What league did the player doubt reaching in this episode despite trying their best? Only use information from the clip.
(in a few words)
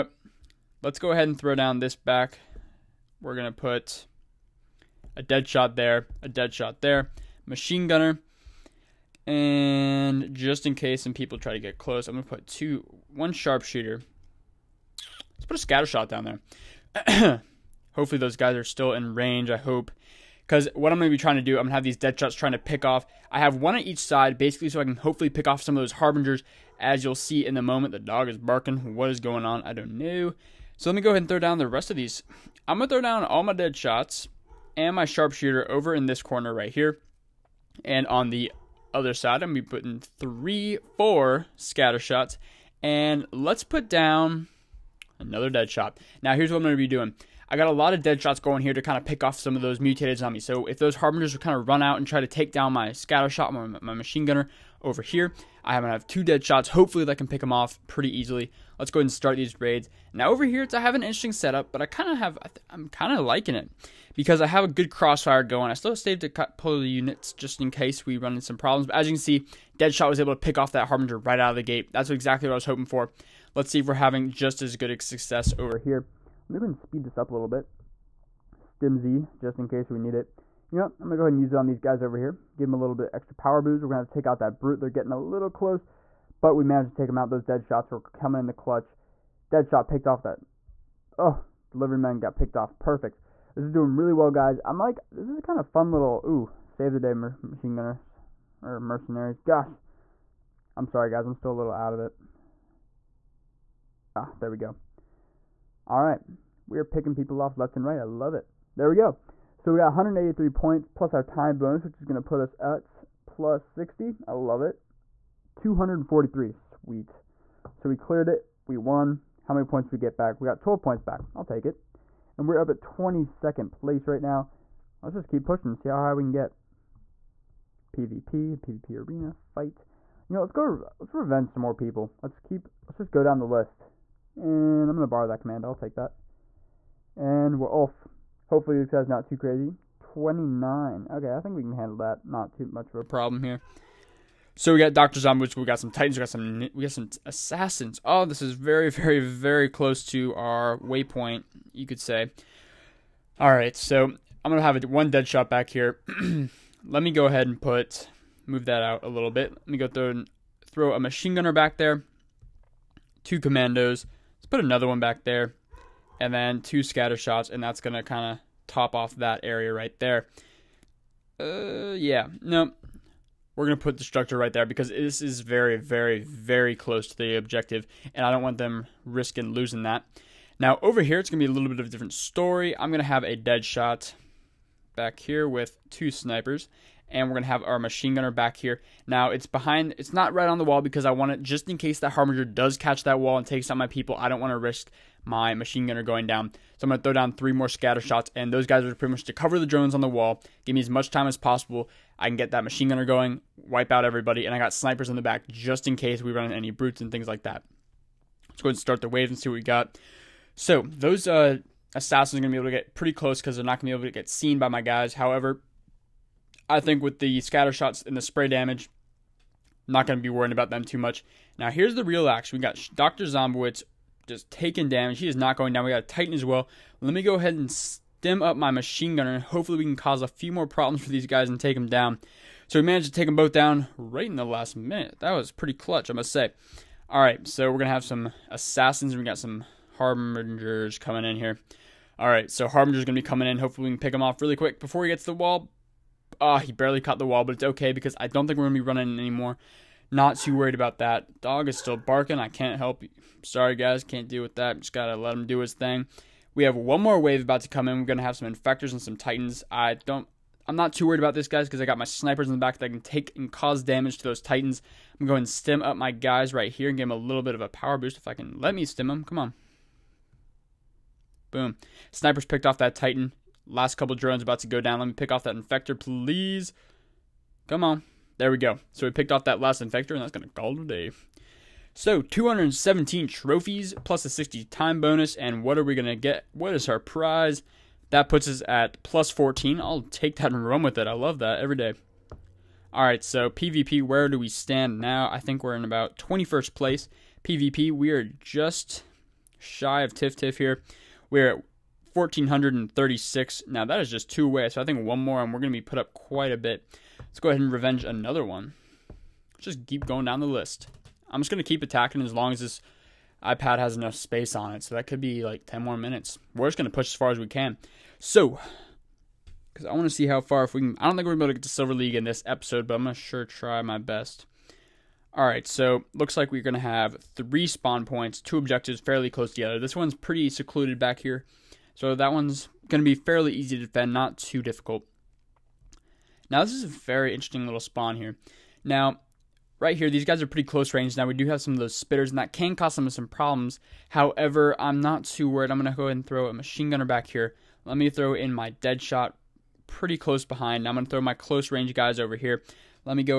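Silver League.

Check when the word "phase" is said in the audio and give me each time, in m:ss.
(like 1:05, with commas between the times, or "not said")
not said.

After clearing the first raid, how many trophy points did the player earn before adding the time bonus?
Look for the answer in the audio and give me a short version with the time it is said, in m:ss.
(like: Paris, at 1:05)
183, at 1:49.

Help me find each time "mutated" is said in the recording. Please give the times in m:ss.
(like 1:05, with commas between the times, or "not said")
0:49.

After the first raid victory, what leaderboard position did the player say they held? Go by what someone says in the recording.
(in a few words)
22nd place.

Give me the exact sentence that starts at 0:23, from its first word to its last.
I have one on each side, basically, so I can hopefully pick off some of those harbingers.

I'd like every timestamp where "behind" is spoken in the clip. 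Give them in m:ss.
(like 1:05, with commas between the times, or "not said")
3:09, 5:50.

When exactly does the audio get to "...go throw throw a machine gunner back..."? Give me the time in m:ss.
2:39.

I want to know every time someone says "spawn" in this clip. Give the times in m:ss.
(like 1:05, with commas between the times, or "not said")
5:27, 5:37.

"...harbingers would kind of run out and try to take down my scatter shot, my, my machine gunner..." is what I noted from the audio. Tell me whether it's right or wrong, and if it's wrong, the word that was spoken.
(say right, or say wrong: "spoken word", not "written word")
right.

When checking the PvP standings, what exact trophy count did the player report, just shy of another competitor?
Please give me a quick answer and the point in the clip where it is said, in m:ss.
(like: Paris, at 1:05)
1,436, at 5:02.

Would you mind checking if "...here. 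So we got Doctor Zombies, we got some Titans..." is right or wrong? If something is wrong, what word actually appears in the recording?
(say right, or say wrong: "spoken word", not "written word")
right.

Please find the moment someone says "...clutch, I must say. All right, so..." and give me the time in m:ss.
3:55.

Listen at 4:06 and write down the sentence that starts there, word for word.
Oh, he barely caught the wall, but it's okay because I don't think we're going to be running anymore.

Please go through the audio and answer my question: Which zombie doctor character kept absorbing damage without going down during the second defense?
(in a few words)
Dr. Zombowitz.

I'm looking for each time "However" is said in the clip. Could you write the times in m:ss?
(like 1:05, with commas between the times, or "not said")
3:35, 5:44.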